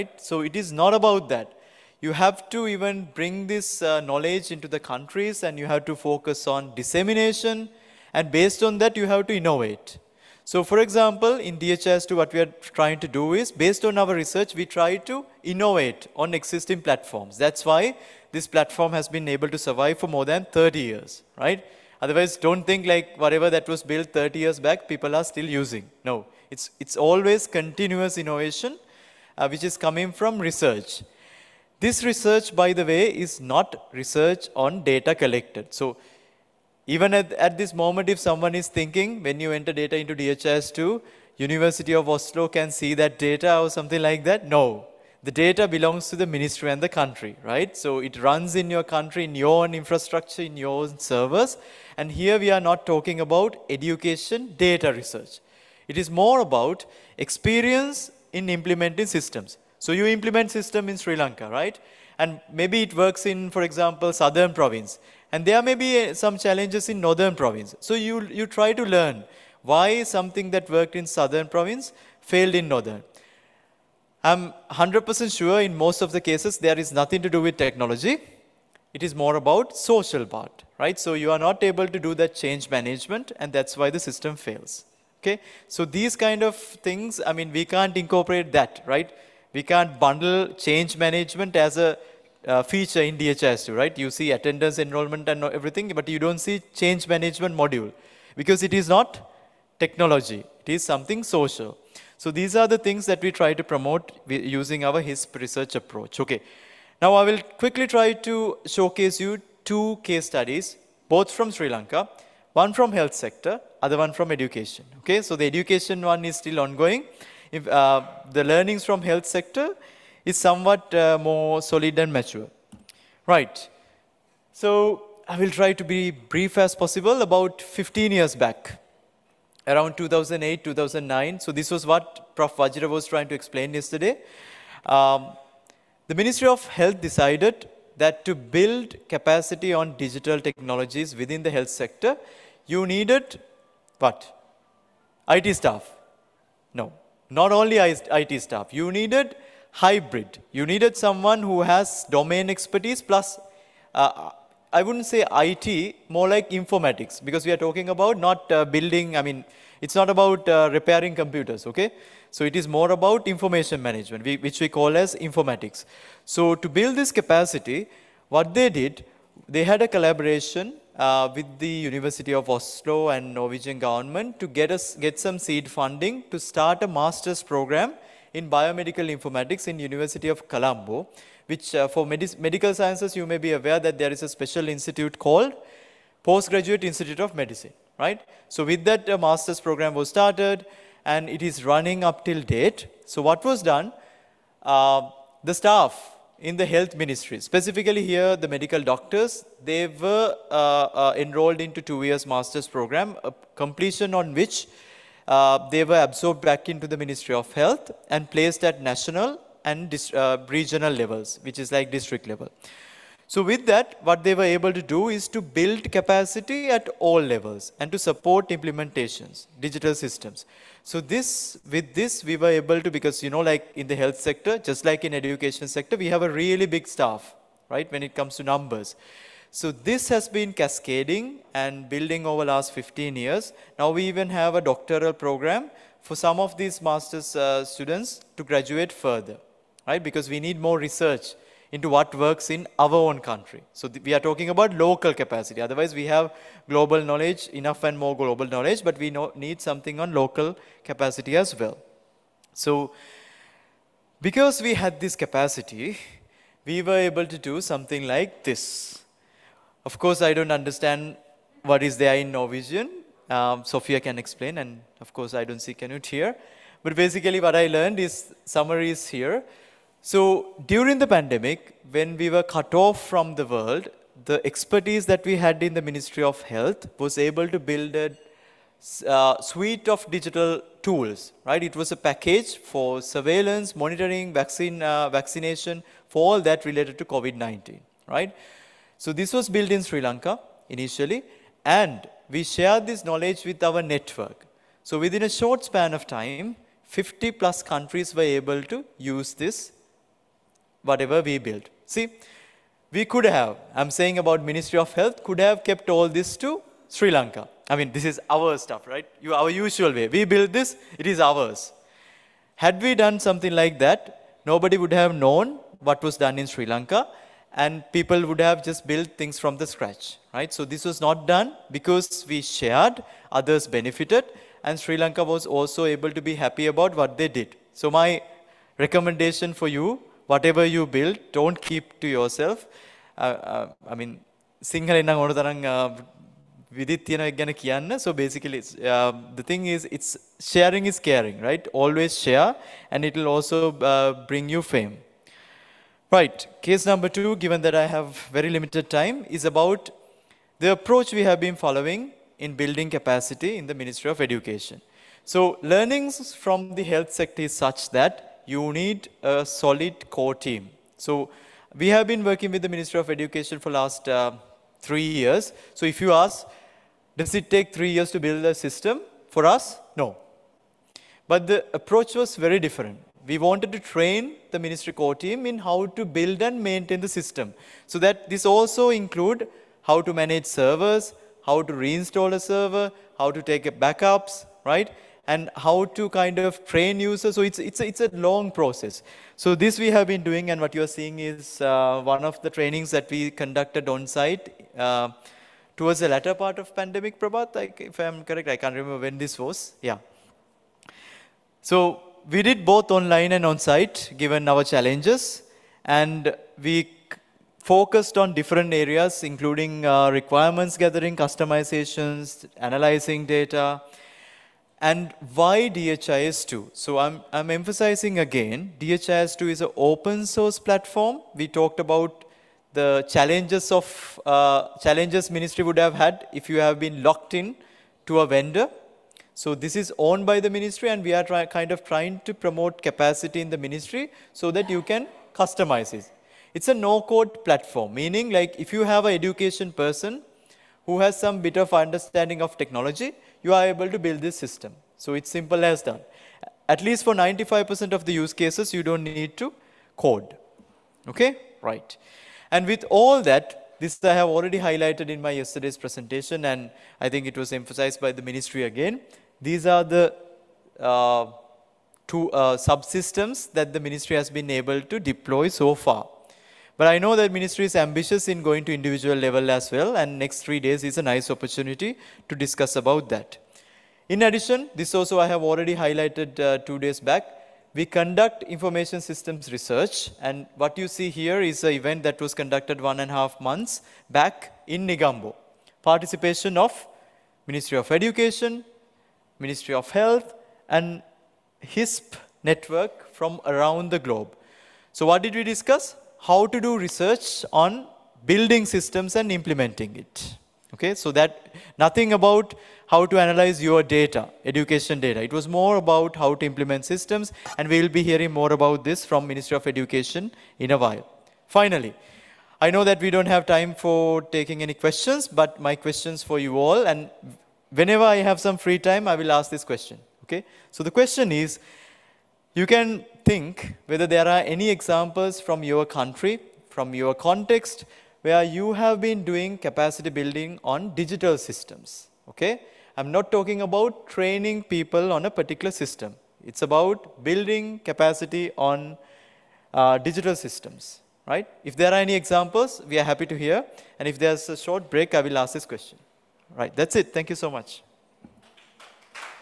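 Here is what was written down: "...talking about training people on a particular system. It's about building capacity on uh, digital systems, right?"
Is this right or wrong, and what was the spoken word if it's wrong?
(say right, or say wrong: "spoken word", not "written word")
right.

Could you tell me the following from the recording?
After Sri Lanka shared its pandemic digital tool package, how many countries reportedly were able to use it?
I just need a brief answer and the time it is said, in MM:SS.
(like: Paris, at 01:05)
50 plus, at 04:56.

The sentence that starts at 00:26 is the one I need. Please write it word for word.
No, it's, it's always continuous innovation, uh, which is coming from research.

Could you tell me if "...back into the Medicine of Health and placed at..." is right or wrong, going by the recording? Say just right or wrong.
wrong.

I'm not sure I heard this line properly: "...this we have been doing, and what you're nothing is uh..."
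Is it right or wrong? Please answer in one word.
wrong.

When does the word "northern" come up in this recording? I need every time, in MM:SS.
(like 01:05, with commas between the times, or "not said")
01:06, 01:12.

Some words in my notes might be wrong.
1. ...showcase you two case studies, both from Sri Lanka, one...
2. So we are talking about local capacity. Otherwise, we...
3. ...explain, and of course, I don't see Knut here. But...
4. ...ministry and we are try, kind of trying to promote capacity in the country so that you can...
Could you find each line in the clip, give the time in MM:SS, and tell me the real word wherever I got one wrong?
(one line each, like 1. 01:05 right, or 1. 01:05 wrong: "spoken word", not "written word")
1. 01:48 right
2. 04:03 right
3. 04:24 right
4. 07:10 wrong: "ministry", not "country".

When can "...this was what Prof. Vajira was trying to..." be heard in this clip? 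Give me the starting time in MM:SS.
02:11.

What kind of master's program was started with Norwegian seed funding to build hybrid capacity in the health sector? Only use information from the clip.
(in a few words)
Biomedical informatics.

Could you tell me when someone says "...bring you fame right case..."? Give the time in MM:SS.
05:44.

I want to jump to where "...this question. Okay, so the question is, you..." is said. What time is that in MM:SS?
08:39.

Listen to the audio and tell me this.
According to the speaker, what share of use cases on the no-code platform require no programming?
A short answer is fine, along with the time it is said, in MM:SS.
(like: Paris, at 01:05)
95%, at 07:27.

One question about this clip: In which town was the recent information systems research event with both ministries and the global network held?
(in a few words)
Negombo.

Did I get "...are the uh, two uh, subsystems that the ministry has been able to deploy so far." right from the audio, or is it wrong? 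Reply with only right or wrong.
right.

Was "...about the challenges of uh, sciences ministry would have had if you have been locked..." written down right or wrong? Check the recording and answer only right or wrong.
wrong.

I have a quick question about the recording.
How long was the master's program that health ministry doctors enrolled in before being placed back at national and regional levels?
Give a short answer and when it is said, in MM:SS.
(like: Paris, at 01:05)
2 years, at 03:21.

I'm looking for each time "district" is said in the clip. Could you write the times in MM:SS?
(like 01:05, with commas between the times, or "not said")
03:31.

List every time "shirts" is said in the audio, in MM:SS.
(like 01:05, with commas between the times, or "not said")
not said.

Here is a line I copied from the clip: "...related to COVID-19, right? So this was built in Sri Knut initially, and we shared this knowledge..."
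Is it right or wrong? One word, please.
wrong.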